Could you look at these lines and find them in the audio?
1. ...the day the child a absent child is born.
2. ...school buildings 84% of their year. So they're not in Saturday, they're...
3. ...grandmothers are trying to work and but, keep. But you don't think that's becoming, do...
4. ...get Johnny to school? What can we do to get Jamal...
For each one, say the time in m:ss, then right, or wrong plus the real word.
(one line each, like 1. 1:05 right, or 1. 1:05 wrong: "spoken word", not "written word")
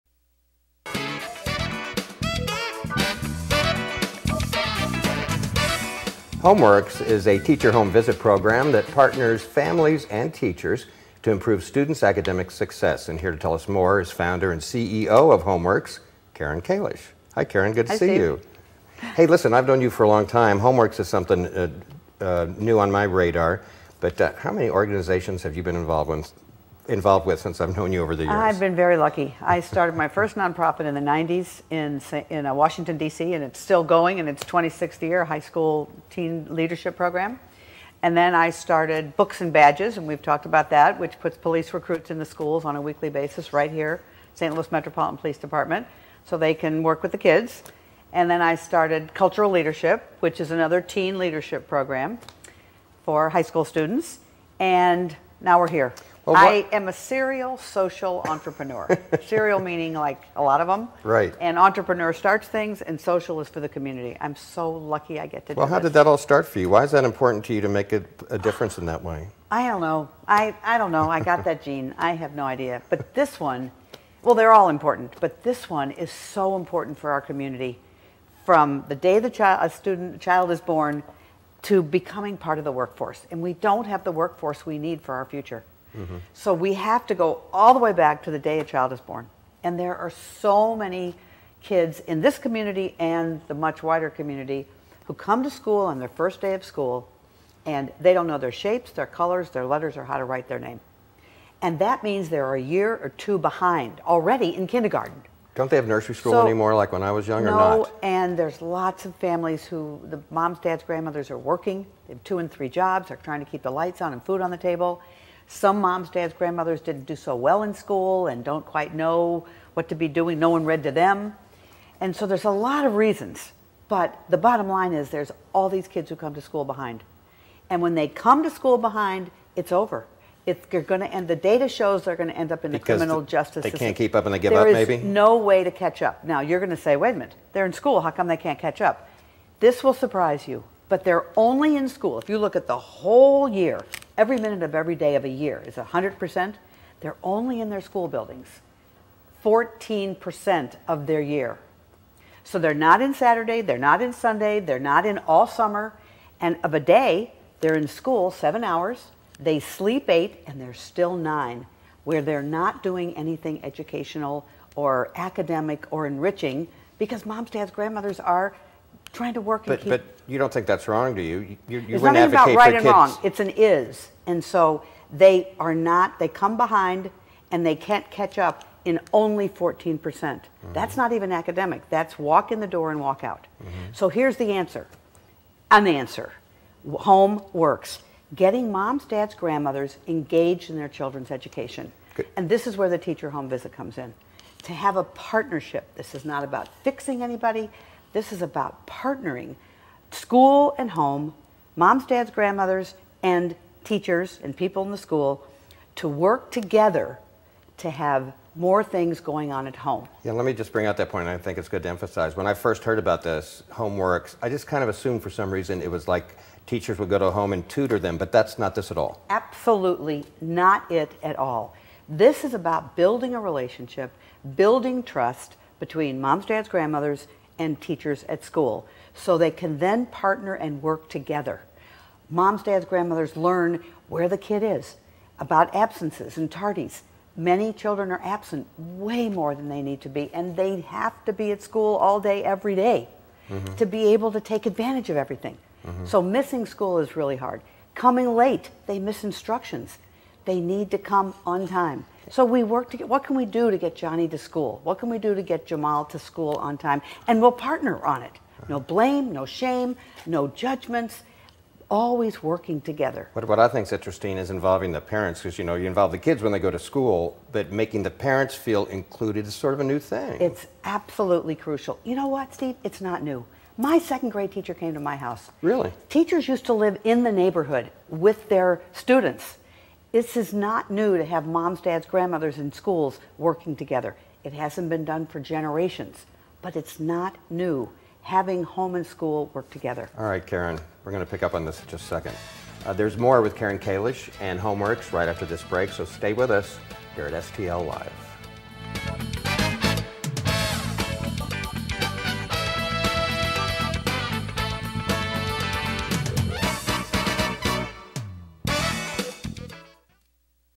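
1. 1:18 wrong: "student", not "absent"
2. 2:27 wrong: "14", not "84"
3. 2:47 wrong: "wrong", not "becoming"
4. 4:13 right.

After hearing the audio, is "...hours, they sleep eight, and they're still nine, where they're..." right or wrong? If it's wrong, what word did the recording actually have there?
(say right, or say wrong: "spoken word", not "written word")
right.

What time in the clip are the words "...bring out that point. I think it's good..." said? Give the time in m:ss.
3:30.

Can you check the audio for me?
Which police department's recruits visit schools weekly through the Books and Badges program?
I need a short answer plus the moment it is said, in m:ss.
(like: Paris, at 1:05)
St. Louis Metropolitan Police Department, at 0:44.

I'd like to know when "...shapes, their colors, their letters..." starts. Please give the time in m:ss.
1:38.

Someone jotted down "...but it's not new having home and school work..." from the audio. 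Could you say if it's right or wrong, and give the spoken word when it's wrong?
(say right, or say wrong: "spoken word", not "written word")
right.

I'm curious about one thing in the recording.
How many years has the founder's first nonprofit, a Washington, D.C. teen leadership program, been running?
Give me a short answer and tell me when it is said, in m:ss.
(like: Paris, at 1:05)
26, at 0:34.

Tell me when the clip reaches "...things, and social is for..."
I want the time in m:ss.
1:02.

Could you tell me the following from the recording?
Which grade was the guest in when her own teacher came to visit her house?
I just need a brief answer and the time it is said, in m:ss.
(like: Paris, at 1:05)
Second grade, at 4:33.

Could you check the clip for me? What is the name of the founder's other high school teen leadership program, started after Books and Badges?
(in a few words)
Cultural Leadership.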